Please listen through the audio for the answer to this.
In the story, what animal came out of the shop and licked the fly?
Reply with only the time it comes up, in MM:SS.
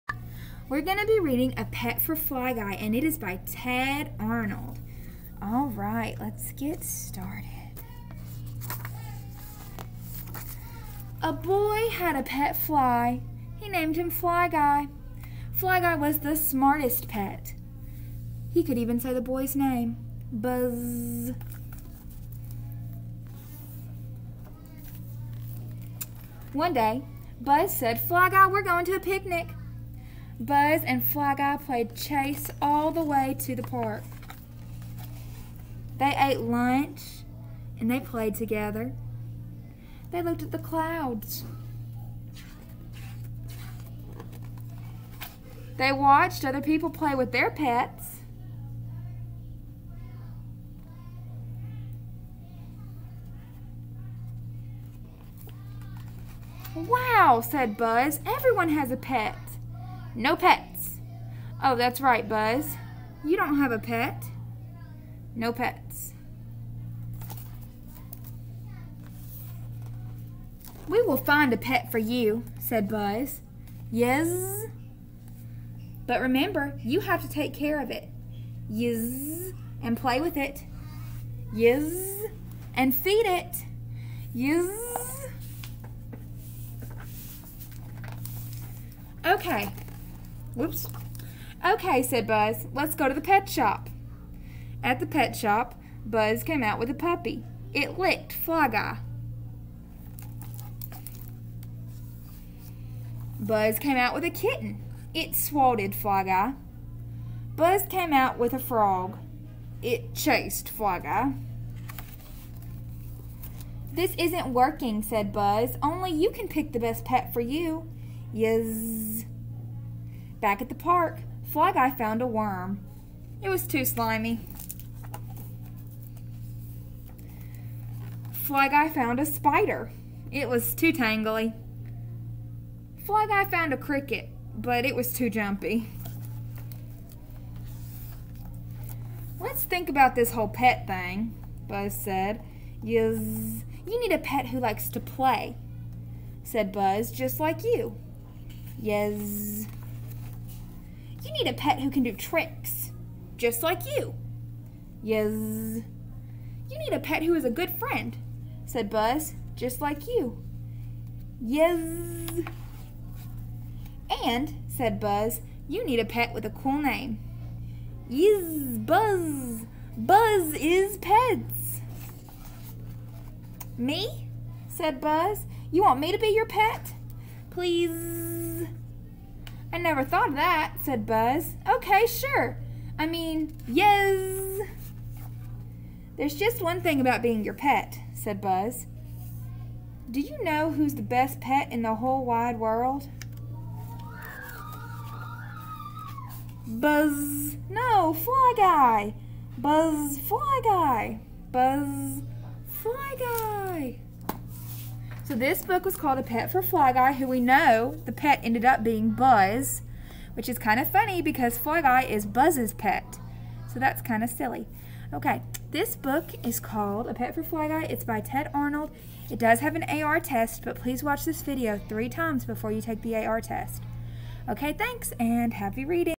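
01:36.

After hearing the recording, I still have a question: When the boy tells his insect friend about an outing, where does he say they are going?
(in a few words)
A picnic.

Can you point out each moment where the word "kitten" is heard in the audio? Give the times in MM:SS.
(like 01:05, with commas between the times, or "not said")
01:44.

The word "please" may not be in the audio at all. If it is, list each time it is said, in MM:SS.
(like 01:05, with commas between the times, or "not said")
02:57, 03:40.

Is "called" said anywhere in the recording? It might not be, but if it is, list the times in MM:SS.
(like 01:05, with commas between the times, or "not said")
03:25, 03:36.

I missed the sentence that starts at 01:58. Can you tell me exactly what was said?
Yes." Back at the park, Fly Guy found a worm.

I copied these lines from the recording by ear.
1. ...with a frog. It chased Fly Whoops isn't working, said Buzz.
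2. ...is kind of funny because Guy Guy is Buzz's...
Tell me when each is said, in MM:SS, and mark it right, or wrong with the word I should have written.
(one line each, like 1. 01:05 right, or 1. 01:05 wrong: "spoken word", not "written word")
1. 01:48 wrong: "This", not "Whoops"
2. 03:30 wrong: "Fly", not "Guy".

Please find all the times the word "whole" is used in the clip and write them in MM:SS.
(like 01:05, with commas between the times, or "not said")
02:20, 03:11.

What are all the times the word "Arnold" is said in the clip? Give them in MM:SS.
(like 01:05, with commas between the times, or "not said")
00:04, 03:38.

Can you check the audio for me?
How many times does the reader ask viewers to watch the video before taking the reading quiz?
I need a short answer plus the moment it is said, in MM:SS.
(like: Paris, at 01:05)
3, at 03:41.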